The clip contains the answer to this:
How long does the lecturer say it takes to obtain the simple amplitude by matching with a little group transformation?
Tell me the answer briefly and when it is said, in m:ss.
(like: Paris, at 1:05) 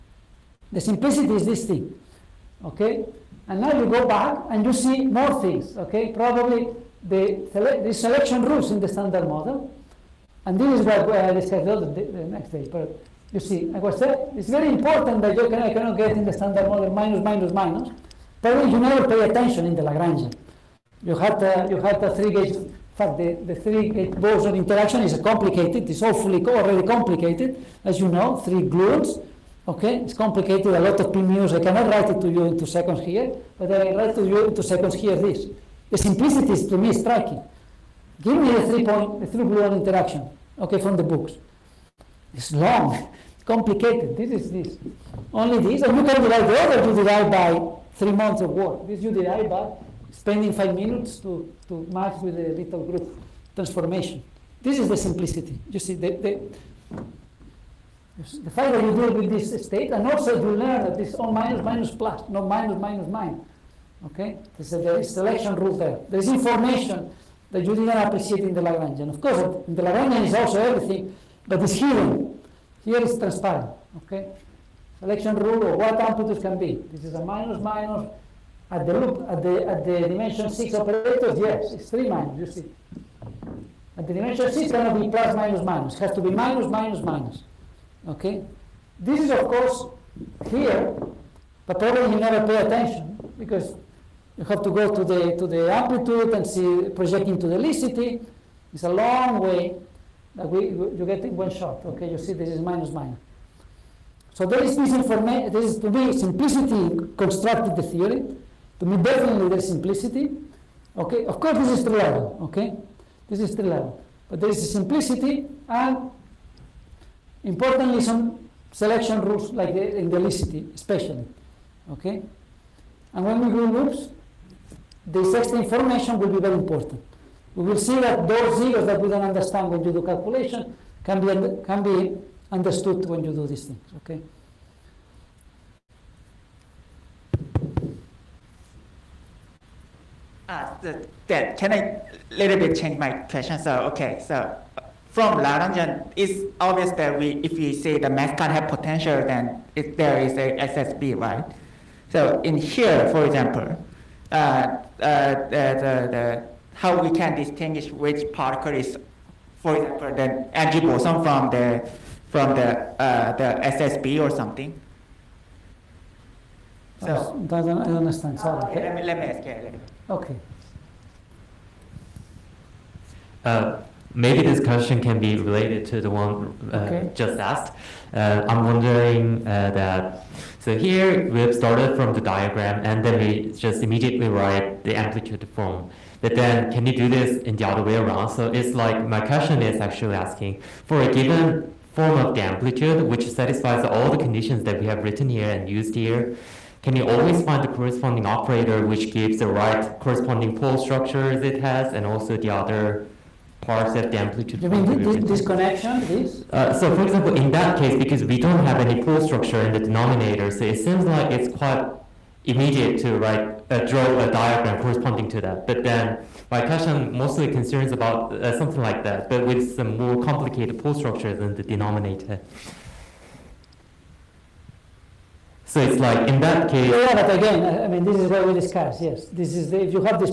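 5 minutes, at 0:50.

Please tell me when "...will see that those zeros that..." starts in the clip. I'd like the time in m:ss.
2:07.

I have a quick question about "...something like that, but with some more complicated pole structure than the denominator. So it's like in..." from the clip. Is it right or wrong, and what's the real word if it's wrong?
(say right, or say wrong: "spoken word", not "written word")
right.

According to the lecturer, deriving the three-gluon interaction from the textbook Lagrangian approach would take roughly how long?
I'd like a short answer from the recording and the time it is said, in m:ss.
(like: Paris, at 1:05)
3 months, at 0:47.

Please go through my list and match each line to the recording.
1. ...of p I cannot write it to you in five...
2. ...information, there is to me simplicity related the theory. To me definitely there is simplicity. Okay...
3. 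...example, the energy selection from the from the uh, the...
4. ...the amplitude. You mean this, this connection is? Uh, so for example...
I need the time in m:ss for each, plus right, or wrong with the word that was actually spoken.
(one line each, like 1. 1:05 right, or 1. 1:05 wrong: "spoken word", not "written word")
1. 0:31 wrong: "two", not "five"
2. 1:44 wrong: "constructed", not "related"
3. 2:39 wrong: "boson", not "selection"
4. 3:24 right.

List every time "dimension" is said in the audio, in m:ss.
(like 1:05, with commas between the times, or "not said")
1:20, 1:24.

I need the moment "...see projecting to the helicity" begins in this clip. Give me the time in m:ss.
1:36.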